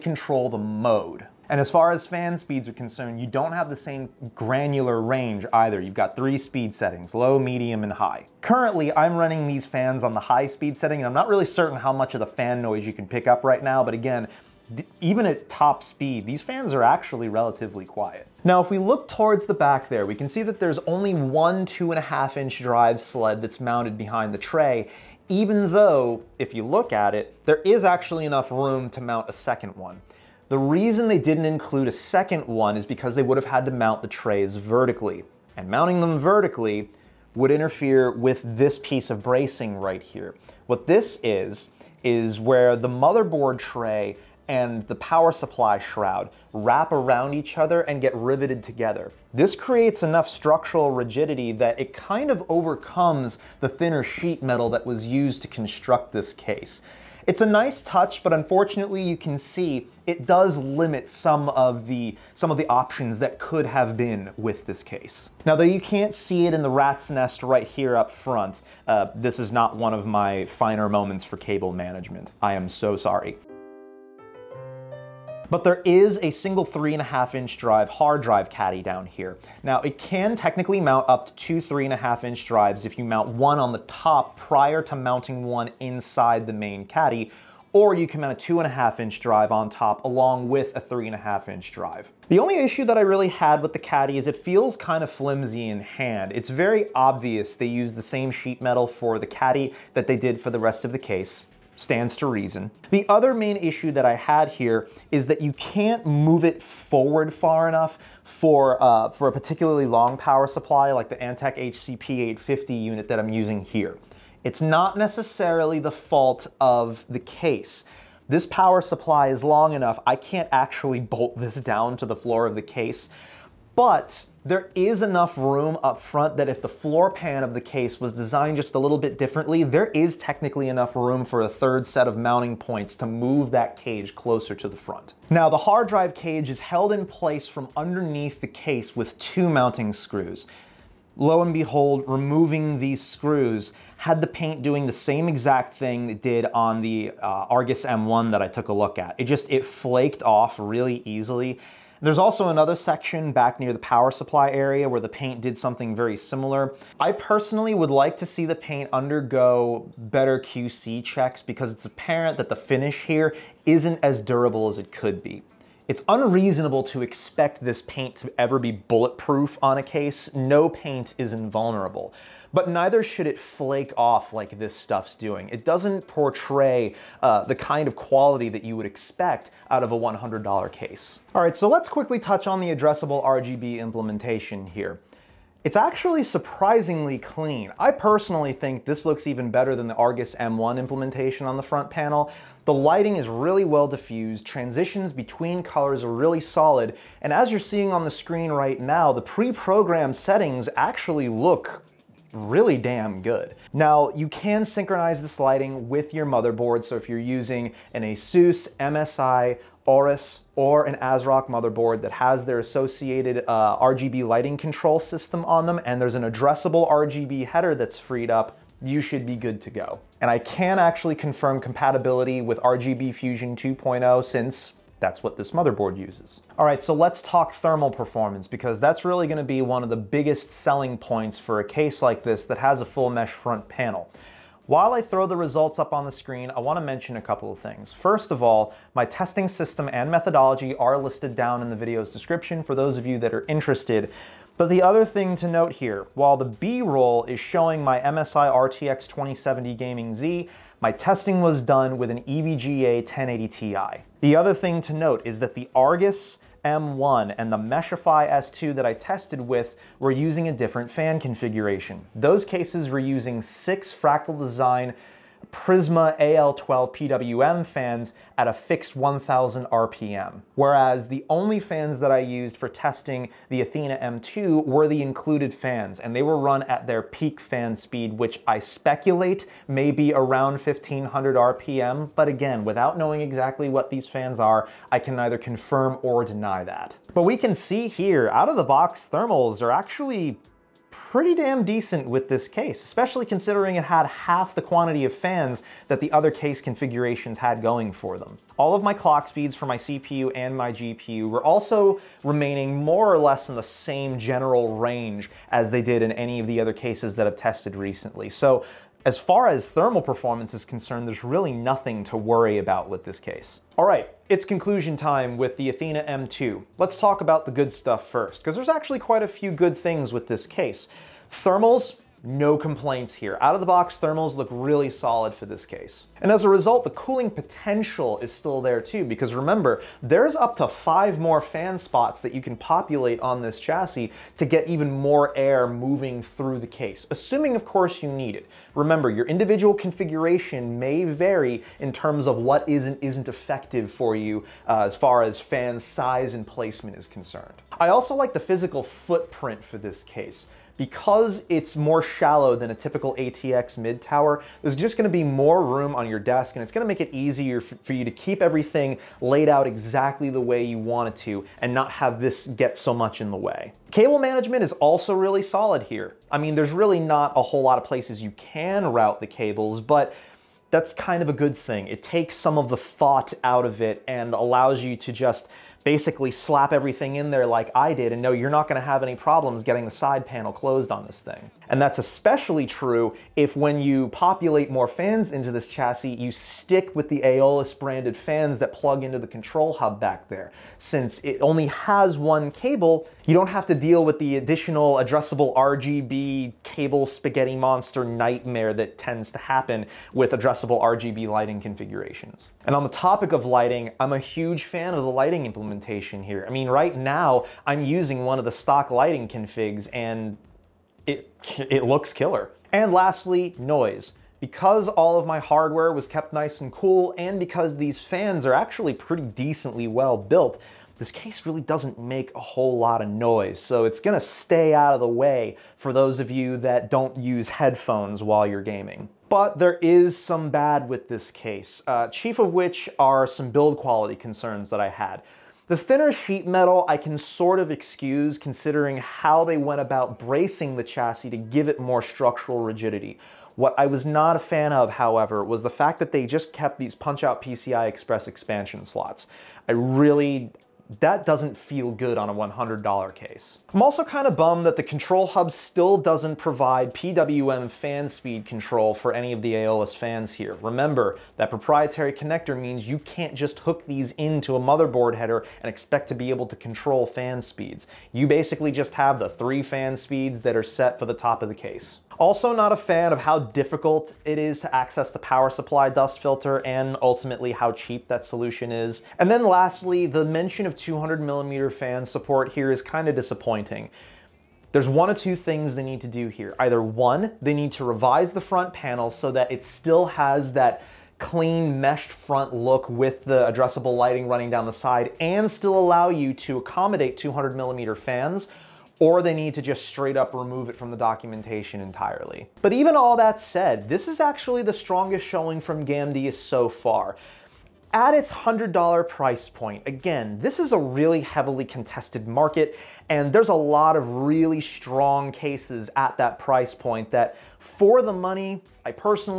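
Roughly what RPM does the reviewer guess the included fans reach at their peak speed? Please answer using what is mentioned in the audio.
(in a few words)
1500 RPM.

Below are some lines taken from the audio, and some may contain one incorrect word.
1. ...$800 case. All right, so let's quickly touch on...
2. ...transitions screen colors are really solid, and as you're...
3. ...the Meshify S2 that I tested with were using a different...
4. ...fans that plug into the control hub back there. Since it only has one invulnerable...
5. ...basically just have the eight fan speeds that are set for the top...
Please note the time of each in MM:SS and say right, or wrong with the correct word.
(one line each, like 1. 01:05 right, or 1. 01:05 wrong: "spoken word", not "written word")
1. 02:59 wrong: "100", not "800"
2. 03:14 wrong: "between", not "screen"
3. 04:17 right
4. 06:28 wrong: "cable", not "invulnerable"
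5. 07:48 wrong: "three", not "eight".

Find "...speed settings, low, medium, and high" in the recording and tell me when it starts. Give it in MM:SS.
00:06.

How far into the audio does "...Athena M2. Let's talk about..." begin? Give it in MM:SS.
05:15.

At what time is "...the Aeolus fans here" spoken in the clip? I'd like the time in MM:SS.
07:39.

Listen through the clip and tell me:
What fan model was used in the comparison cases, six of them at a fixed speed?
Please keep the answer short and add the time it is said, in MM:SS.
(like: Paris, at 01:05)
Prisma AL12 PWM, at 04:25.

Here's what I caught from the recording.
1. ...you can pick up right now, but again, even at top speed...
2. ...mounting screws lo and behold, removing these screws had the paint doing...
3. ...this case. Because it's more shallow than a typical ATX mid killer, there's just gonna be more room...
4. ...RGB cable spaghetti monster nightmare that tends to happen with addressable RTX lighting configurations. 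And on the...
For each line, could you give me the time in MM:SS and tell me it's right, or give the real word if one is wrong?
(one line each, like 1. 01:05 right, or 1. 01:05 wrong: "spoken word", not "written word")
1. 00:12 right
2. 02:19 right
3. 05:49 wrong: "tower", not "killer"
4. 06:35 wrong: "RGB", not "RTX".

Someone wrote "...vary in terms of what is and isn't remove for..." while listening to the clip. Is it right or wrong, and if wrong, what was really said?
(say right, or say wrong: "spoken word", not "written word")
wrong: "effective", not "remove".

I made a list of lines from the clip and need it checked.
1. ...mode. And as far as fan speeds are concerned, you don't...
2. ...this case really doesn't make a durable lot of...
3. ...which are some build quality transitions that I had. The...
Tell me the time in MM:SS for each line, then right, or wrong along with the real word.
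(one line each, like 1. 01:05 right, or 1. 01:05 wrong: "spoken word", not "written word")
1. 00:00 right
2. 07:00 wrong: "whole", not "durable"
3. 07:12 wrong: "concerns", not "transitions".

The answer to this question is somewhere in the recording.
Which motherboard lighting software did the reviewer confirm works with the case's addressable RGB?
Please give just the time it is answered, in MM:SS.
03:42.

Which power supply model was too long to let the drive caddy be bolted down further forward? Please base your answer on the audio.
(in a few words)
Antec HCP850.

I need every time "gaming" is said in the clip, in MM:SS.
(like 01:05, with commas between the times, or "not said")
04:09, 07:08.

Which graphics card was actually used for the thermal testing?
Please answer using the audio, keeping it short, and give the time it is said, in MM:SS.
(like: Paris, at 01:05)
EVGA 1080 Ti, at 04:12.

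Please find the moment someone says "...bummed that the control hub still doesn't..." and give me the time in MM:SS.
07:34.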